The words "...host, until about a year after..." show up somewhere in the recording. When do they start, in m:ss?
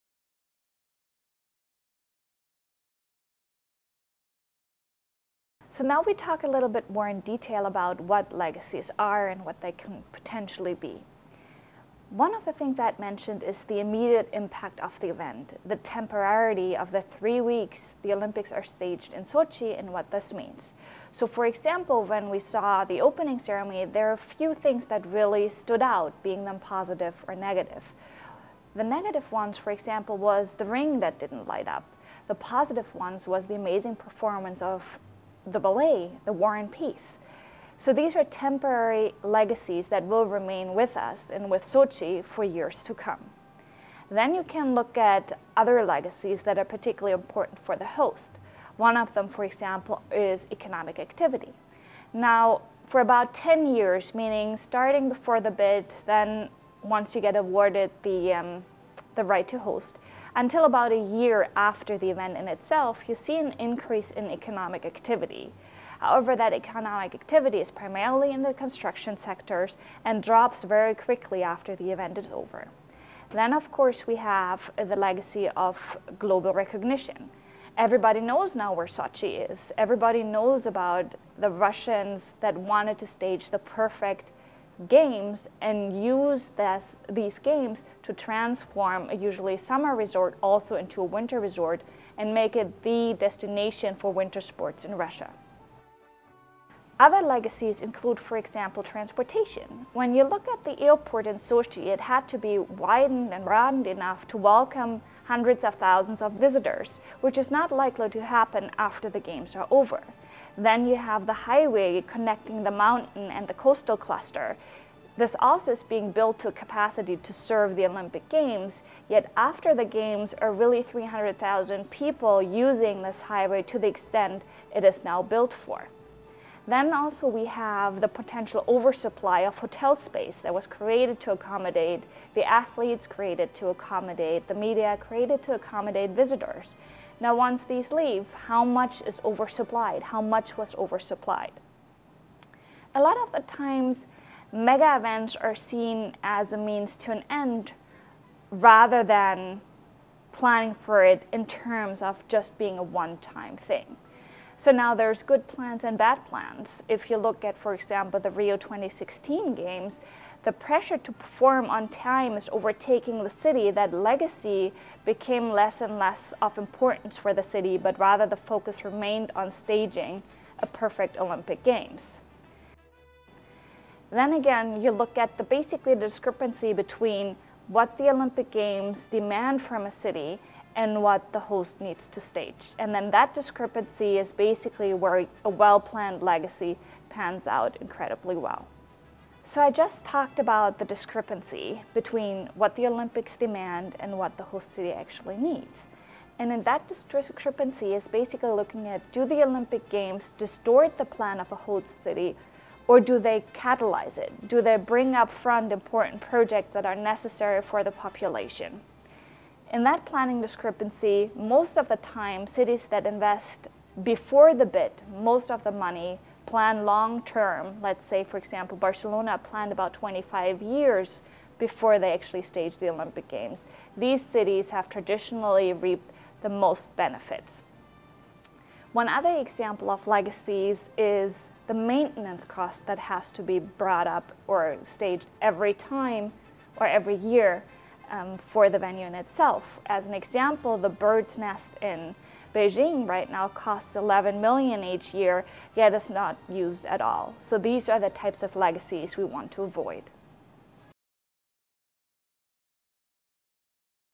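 0:59.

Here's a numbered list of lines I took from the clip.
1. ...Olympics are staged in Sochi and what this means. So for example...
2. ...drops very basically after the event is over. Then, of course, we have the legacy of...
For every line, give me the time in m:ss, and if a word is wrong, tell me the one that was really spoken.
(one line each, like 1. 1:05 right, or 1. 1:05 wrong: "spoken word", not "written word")
1. 0:18 right
2. 1:10 wrong: "quickly", not "basically".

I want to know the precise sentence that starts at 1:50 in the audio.
Then you have the highway connecting the mountain and the coastal cluster.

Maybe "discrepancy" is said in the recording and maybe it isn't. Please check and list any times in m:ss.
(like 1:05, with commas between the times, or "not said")
2:56, 3:03, 3:10, 3:16, 3:30.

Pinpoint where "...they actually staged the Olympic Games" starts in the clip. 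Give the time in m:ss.
3:41.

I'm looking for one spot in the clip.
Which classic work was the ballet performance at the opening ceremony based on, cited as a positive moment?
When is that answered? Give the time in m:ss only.
0:36.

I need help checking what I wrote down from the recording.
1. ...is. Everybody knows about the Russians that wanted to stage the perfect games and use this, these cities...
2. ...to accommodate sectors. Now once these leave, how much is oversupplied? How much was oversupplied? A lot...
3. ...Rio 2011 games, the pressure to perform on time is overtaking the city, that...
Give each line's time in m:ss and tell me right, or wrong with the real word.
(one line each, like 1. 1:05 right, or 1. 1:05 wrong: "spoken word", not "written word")
1. 1:19 wrong: "games", not "cities"
2. 2:15 wrong: "visitors", not "sectors"
3. 2:38 wrong: "2016", not "2011".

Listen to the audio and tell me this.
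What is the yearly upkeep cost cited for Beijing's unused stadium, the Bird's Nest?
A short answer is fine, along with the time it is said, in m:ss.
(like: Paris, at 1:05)
11 million, at 4:03.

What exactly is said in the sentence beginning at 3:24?
Do they bring up front important projects that are necessary for the population?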